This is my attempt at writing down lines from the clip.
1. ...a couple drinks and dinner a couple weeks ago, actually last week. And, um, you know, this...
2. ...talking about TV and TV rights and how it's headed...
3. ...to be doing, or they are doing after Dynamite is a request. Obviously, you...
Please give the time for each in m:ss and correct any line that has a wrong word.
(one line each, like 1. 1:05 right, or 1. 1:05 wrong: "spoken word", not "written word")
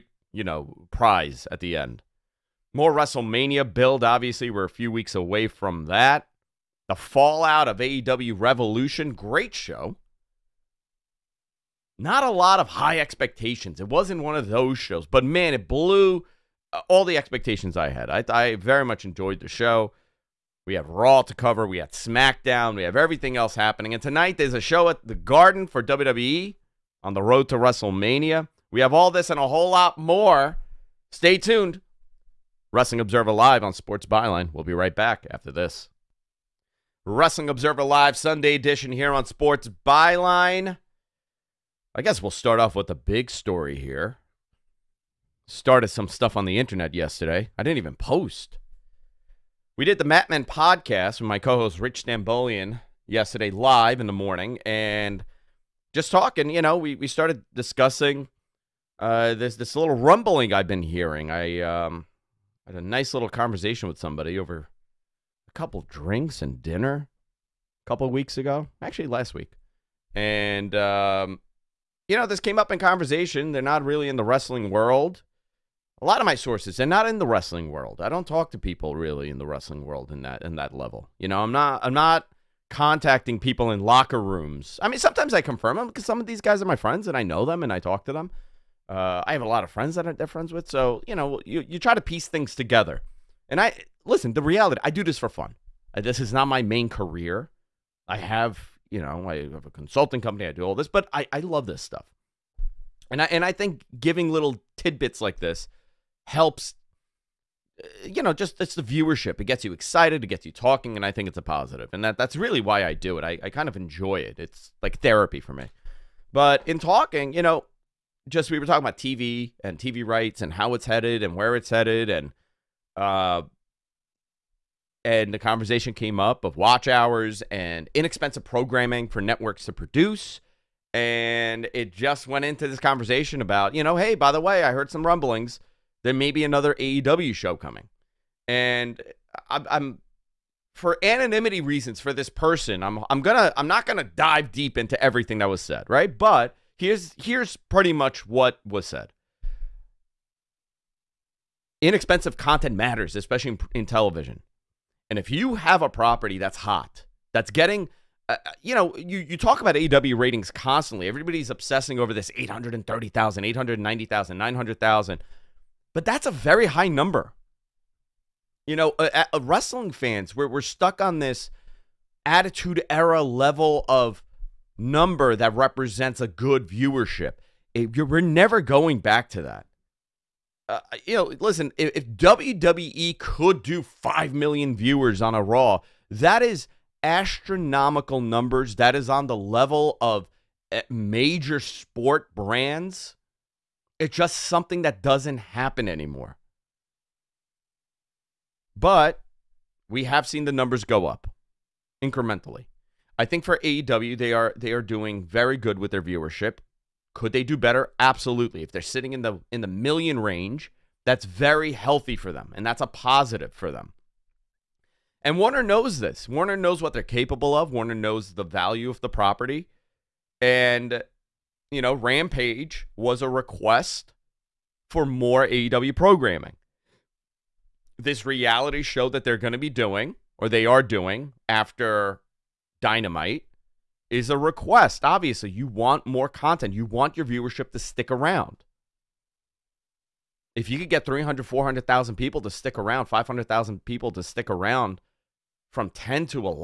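1. 1:05 right
2. 1:58 right
3. 3:49 right.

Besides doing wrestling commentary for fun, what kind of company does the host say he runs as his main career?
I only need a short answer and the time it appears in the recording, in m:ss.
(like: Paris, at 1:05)
consulting company, at 1:39.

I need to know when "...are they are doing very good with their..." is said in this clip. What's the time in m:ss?
3:24.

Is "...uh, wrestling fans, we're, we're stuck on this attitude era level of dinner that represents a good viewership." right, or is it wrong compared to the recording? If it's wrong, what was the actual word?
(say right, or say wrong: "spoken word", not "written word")
wrong: "number", not "dinner".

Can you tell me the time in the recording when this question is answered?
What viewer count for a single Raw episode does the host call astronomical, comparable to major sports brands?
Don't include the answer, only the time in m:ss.
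3:03.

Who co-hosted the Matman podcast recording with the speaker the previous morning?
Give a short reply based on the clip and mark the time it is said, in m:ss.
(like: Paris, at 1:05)
Rich Stambolian, at 0:51.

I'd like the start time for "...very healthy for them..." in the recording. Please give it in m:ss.
3:31.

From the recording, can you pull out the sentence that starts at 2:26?
But Here's here's pretty much what was said.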